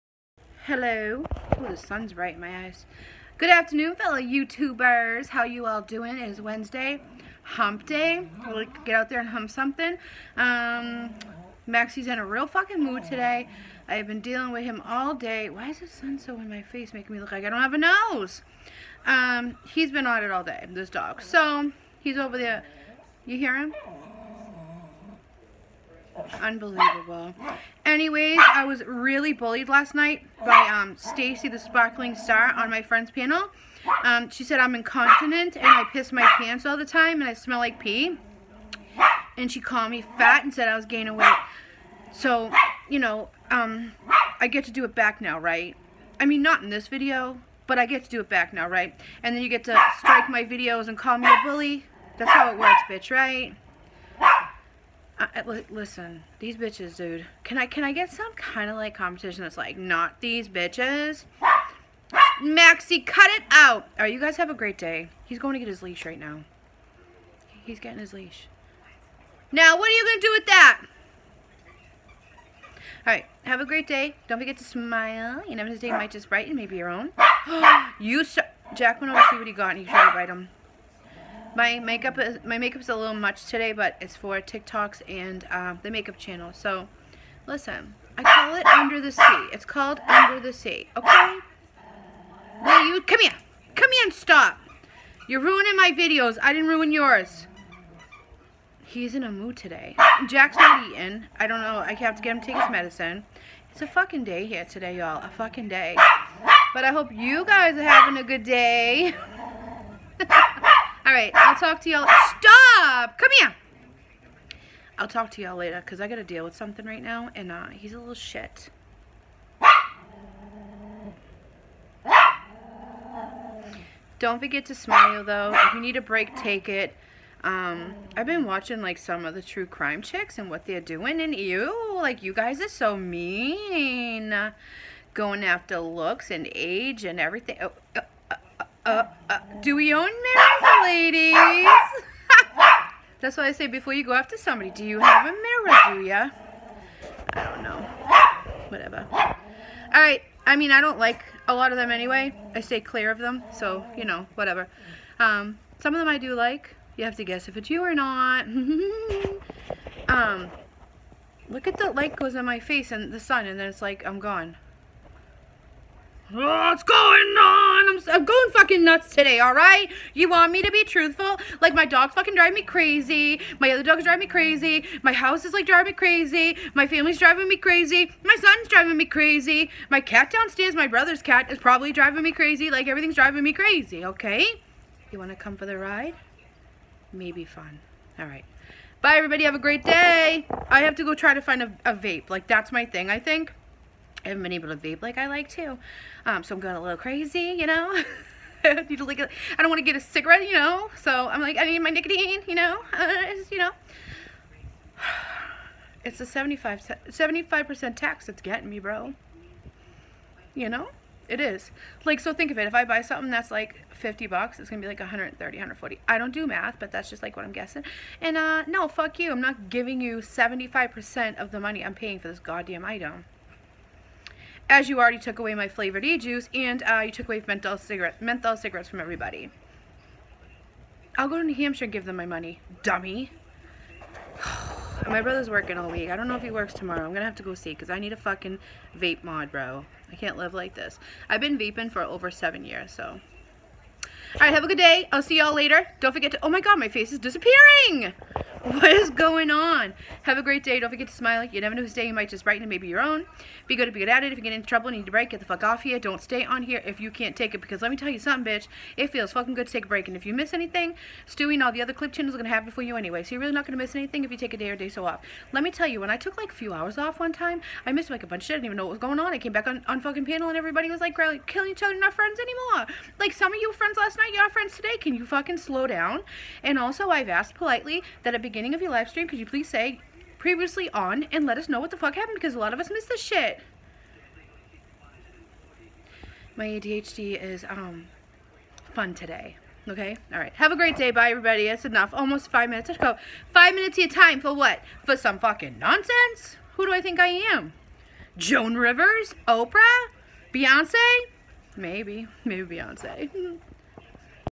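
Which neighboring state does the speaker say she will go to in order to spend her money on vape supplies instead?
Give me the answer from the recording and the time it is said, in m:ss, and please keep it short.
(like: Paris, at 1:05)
New Hampshire, at 3:51.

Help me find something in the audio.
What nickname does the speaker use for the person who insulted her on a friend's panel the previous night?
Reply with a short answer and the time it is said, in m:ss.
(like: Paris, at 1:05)
Stacy, the sparkling star, at 0:30.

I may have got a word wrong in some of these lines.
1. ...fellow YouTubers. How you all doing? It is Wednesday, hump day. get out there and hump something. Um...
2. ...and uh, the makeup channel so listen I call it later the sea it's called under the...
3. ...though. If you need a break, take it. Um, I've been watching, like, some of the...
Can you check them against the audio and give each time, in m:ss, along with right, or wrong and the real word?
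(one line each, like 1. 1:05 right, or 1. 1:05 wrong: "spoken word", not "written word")
1. 0:03 right
2. 1:25 wrong: "under", not "later"
3. 2:05 right.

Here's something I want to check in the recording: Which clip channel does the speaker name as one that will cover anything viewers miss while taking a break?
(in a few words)
Stewie.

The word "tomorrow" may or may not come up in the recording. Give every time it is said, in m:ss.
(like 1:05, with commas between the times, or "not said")
3:56.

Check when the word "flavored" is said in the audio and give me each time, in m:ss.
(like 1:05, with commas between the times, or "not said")
3:45.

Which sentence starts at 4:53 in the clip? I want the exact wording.
Five minutes of your time for what?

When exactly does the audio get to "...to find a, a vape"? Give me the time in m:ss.
3:11.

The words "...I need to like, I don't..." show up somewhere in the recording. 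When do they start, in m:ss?
3:18.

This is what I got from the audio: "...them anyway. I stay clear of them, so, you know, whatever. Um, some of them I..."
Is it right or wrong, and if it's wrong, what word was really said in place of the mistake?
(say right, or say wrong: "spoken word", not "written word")
right.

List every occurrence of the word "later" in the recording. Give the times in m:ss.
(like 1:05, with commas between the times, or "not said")
1:55, 4:05.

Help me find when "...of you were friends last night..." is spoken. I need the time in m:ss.
4:33.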